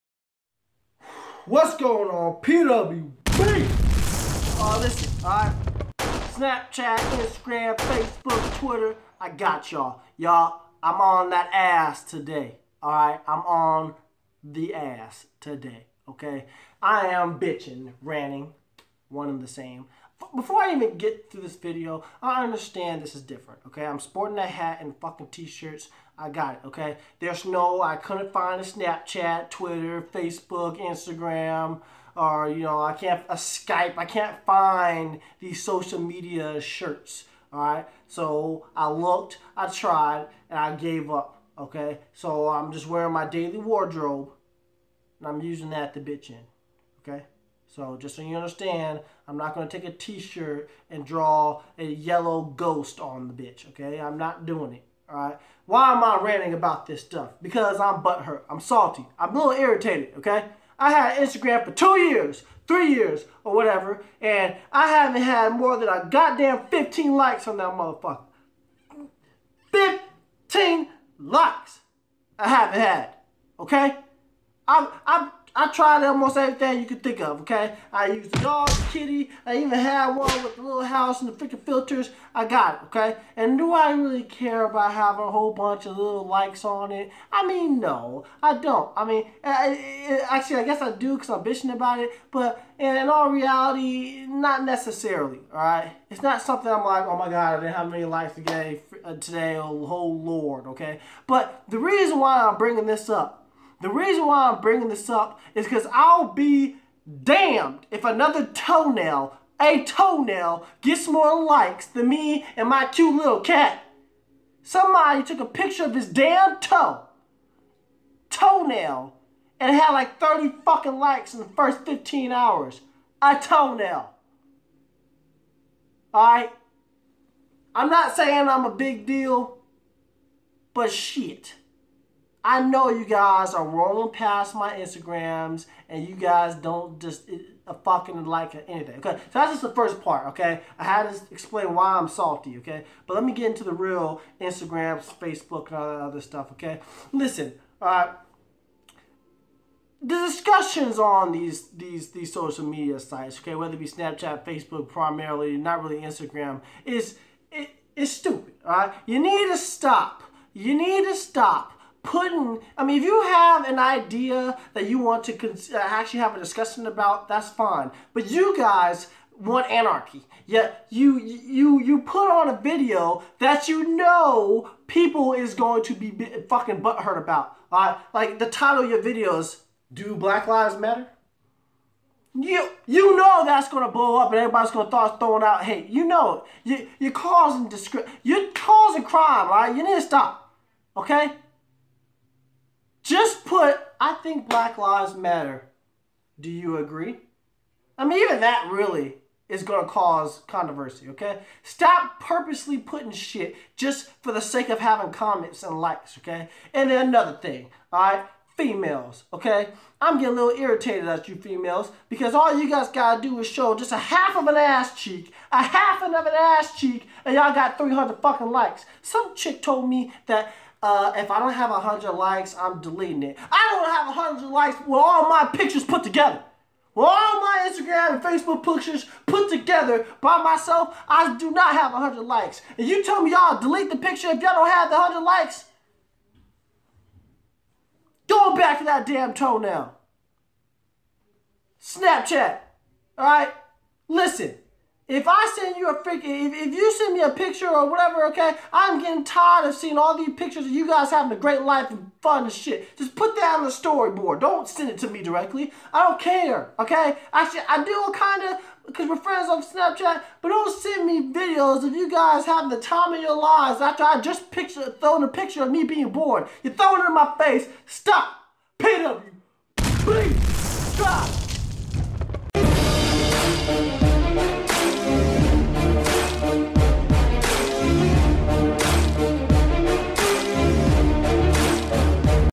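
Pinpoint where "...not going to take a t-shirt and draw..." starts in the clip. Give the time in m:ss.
0:49.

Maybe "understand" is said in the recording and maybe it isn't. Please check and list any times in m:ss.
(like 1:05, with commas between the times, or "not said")
0:22, 0:48.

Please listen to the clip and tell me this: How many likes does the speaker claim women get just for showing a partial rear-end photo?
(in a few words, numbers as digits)
300.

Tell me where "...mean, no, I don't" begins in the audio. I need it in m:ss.
1:27.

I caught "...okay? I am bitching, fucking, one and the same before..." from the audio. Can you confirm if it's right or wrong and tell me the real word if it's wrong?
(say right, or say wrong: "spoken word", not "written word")
wrong: "ranting", not "fucking".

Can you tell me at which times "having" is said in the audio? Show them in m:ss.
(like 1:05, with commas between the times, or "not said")
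1:24, 3:24, 4:11, 4:22.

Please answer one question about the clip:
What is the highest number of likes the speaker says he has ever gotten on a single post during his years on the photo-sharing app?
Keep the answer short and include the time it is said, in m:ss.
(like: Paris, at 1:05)
15, at 1:09.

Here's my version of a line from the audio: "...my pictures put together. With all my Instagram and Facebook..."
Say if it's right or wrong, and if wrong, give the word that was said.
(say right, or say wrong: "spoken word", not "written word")
right.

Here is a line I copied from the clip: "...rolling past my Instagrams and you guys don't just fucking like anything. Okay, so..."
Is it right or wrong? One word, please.
right.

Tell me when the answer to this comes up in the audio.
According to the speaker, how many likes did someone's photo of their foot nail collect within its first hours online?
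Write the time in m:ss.
1:59.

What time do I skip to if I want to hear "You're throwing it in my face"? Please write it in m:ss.
4:26.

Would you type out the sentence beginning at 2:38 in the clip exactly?
All right, you need to stop.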